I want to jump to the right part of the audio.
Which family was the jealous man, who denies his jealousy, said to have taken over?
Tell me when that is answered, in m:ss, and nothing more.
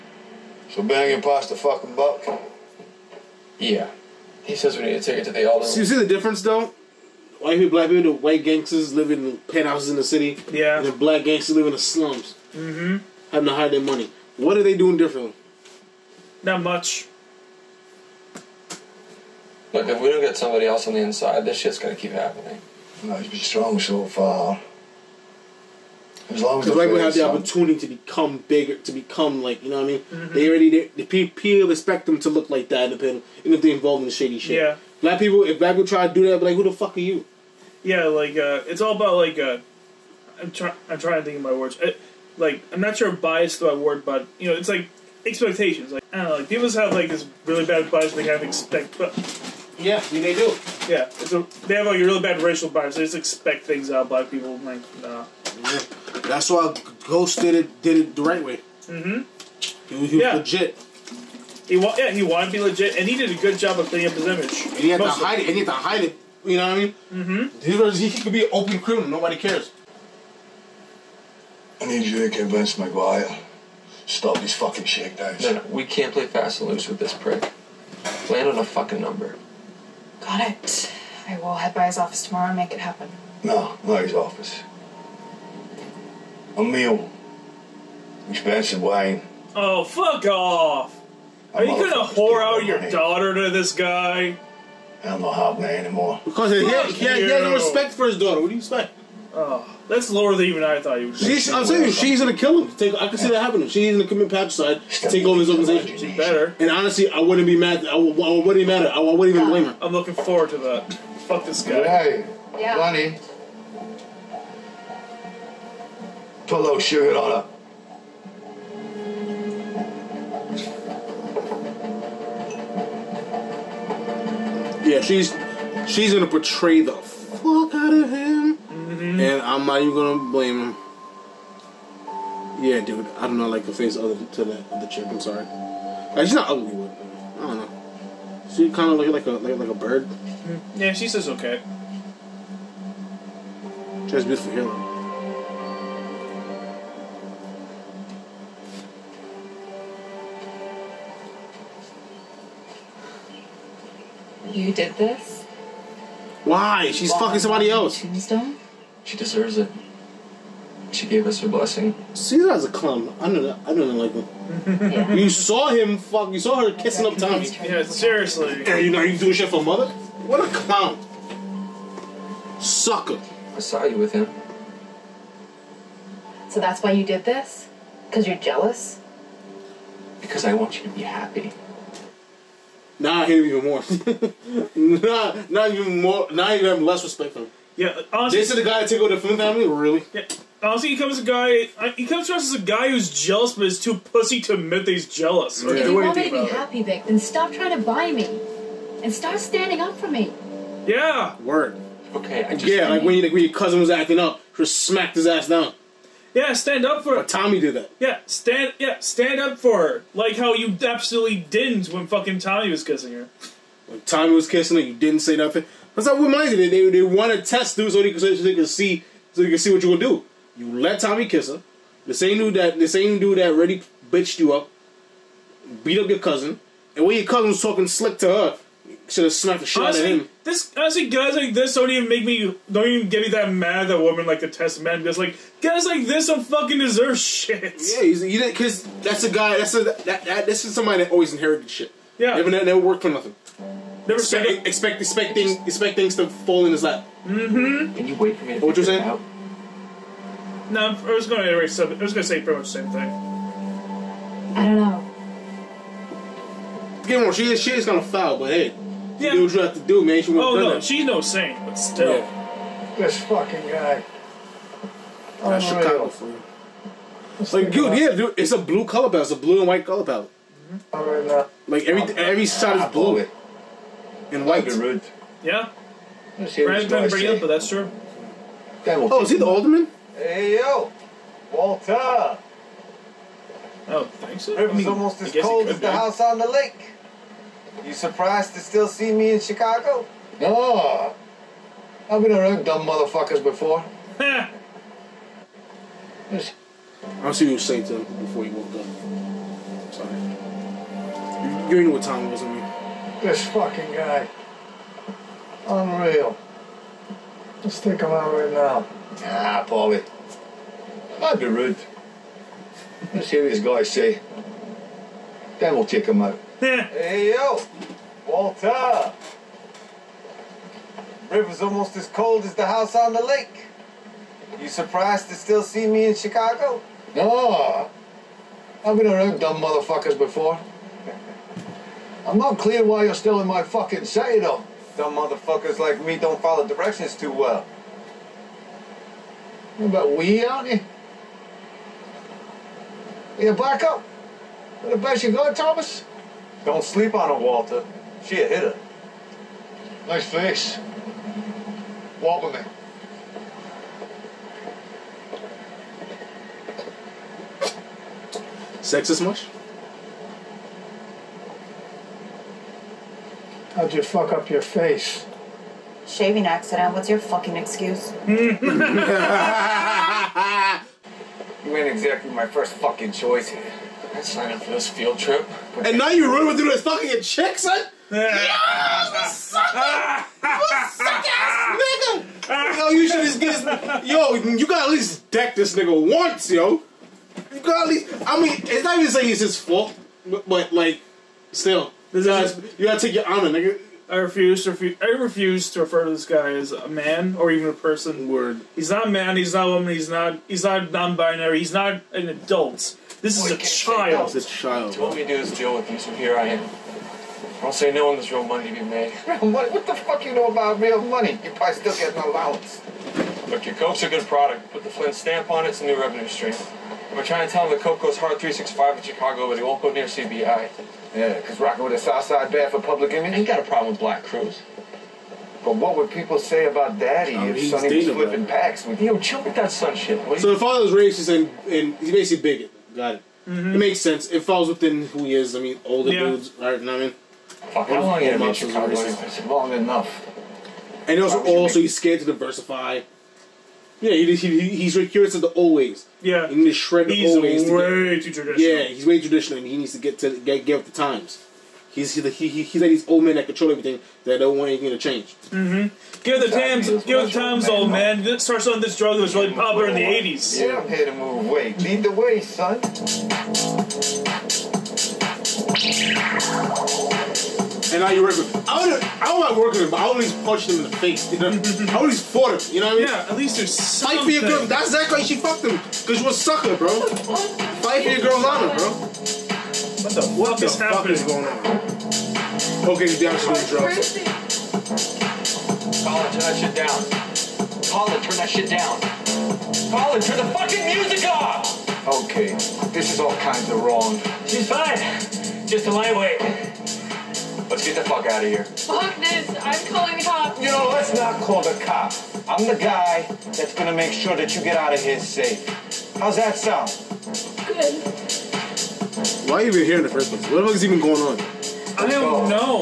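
3:09.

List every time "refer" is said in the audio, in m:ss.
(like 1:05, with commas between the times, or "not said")
6:35.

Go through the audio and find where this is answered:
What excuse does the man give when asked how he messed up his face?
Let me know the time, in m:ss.
6:06.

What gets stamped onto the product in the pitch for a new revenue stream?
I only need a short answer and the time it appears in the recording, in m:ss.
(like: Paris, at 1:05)
The Flynn stamp, at 6:54.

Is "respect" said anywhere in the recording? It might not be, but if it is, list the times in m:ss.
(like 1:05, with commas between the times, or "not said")
1:37, 3:07.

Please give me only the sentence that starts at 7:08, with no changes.
With, Yo, chill with that son shit.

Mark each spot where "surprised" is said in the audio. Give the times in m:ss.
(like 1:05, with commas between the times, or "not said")
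4:47, 5:24.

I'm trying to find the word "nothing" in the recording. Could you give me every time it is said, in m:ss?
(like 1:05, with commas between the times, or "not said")
3:35, 4:03.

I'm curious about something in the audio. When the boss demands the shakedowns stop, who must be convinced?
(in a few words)
McGuire.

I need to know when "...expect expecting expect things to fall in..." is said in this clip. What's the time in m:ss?
4:04.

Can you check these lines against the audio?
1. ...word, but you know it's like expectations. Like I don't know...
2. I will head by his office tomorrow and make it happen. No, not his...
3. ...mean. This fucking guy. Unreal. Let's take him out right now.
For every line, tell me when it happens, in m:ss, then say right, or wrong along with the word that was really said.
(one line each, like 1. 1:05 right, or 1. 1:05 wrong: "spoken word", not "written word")
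1. 0:43 right
2. 1:21 right
3. 5:02 right.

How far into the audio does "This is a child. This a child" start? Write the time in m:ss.
6:43.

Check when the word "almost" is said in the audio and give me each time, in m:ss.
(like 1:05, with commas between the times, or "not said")
4:44, 5:21.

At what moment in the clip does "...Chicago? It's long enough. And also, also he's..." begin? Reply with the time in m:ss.
7:18.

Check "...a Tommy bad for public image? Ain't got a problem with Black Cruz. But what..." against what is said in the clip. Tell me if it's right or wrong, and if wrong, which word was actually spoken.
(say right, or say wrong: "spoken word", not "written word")
wrong: "Southside", not "Tommy".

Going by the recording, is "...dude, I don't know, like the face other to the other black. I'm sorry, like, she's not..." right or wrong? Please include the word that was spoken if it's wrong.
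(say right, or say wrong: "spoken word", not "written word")
wrong: "chick", not "black".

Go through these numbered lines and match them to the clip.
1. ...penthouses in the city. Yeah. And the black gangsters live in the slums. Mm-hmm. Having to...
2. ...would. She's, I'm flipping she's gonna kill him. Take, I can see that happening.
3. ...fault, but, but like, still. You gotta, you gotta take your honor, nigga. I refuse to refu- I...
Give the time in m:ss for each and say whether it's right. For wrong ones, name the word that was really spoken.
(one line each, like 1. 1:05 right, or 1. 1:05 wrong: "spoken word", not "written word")
1. 0:09 right
2. 1:41 wrong: "saying", not "flipping"
3. 6:29 right.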